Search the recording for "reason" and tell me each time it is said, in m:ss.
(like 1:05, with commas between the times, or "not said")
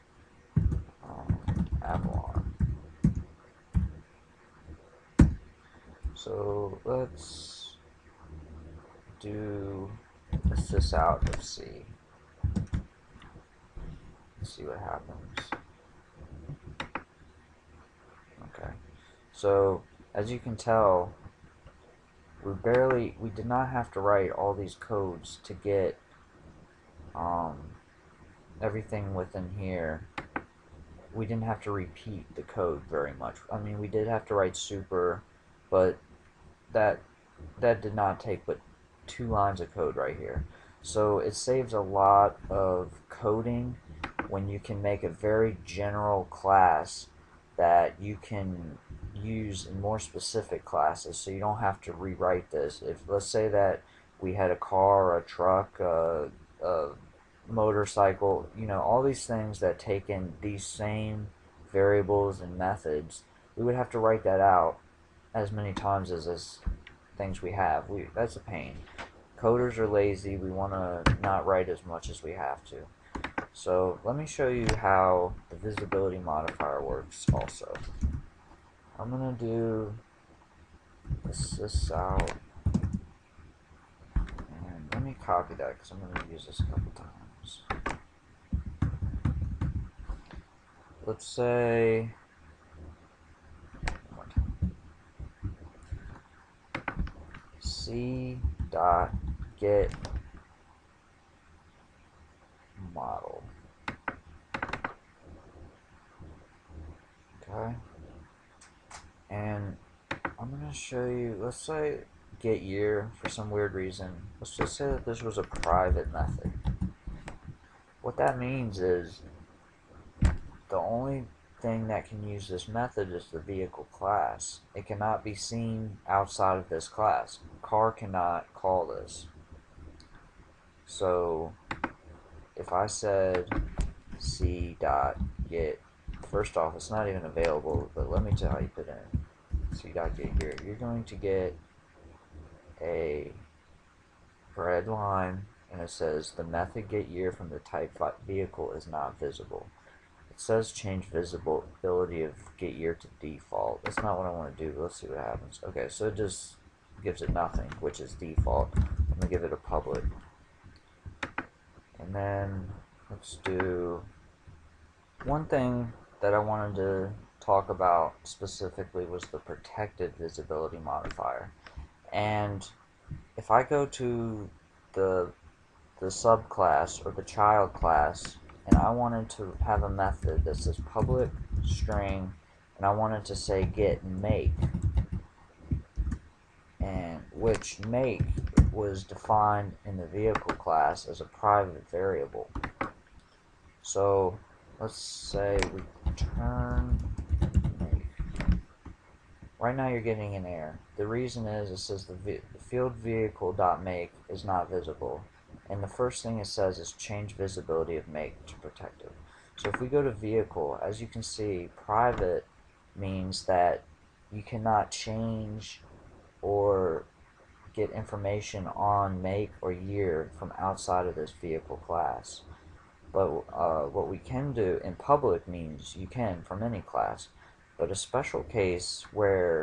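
1:53, 3:21.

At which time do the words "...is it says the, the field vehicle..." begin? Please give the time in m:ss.
3:21.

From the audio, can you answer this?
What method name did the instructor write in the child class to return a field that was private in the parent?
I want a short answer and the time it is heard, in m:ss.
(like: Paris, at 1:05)
get make, at 3:03.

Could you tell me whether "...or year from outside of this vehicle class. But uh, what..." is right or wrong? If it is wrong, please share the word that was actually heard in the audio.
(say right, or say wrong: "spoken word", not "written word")
right.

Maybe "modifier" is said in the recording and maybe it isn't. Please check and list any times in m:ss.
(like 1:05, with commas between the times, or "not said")
1:16, 2:50.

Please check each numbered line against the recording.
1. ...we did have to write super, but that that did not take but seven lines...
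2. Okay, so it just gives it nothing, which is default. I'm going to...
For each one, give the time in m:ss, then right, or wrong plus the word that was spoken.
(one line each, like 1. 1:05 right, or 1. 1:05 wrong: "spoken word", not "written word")
1. 0:33 wrong: "two", not "seven"
2. 2:35 right.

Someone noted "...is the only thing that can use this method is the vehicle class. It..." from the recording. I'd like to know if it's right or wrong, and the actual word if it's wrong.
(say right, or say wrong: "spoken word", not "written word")
right.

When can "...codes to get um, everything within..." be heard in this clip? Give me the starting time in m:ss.
0:24.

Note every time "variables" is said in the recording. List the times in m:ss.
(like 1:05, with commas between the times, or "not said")
1:01, 3:11.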